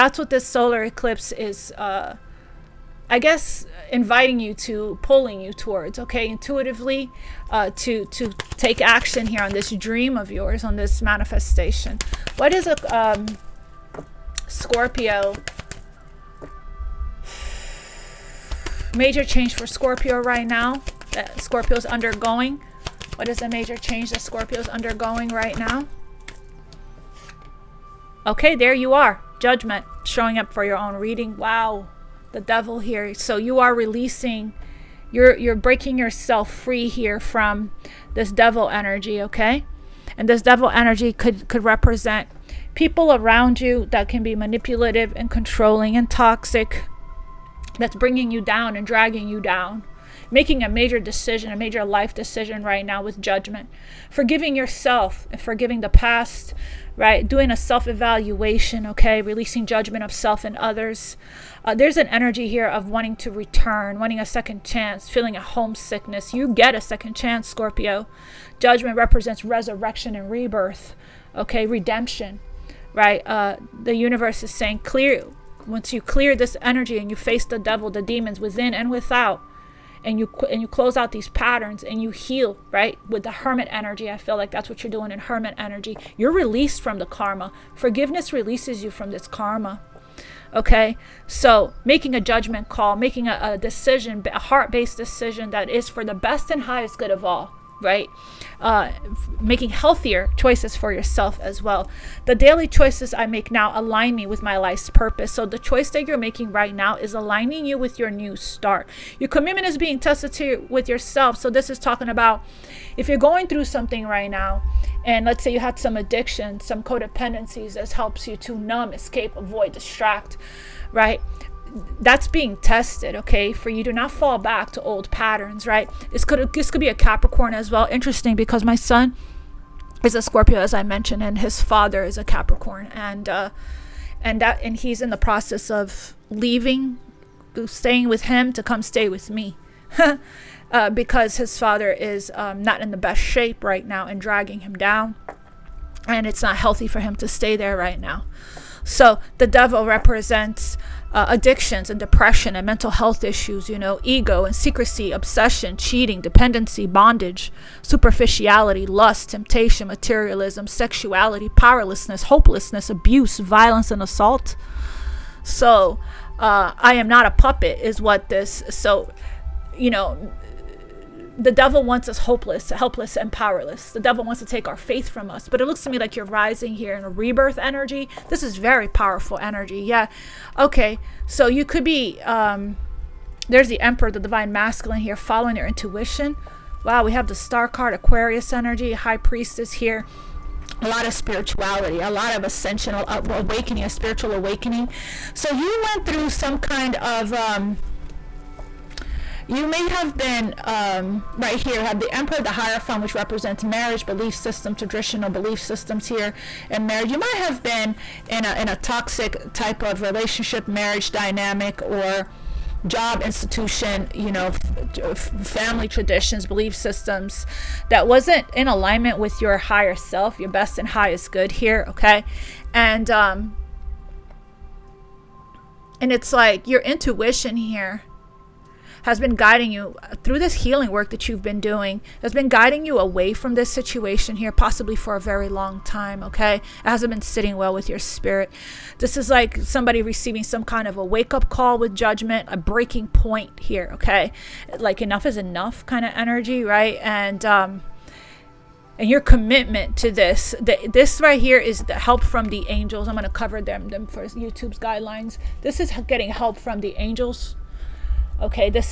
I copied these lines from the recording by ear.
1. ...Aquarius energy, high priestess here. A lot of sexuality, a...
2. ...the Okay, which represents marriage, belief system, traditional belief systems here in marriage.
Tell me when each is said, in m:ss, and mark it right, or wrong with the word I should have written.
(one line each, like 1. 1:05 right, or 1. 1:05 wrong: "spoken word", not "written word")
1. 3:07 wrong: "spirituality", not "sexuality"
2. 3:22 wrong: "Hierophant", not "Okay".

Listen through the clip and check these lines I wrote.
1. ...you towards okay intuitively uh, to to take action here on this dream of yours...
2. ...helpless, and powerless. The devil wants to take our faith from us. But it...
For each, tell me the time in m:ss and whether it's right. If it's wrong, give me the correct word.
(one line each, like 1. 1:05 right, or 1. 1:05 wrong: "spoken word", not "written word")
1. 0:05 right
2. 2:52 right.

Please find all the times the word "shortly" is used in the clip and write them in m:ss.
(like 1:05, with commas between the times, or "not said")
not said.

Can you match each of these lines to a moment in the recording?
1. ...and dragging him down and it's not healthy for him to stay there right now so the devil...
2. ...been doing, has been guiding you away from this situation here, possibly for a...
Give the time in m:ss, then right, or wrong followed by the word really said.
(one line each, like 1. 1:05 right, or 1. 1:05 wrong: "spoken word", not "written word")
1. 2:24 right
2. 3:51 right.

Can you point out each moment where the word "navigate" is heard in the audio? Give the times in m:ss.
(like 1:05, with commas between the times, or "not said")
not said.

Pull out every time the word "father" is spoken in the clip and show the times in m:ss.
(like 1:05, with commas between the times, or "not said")
2:11, 2:21.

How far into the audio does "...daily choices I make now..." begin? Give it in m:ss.
1:42.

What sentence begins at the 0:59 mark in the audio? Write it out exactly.
Releasing judgment of self and others.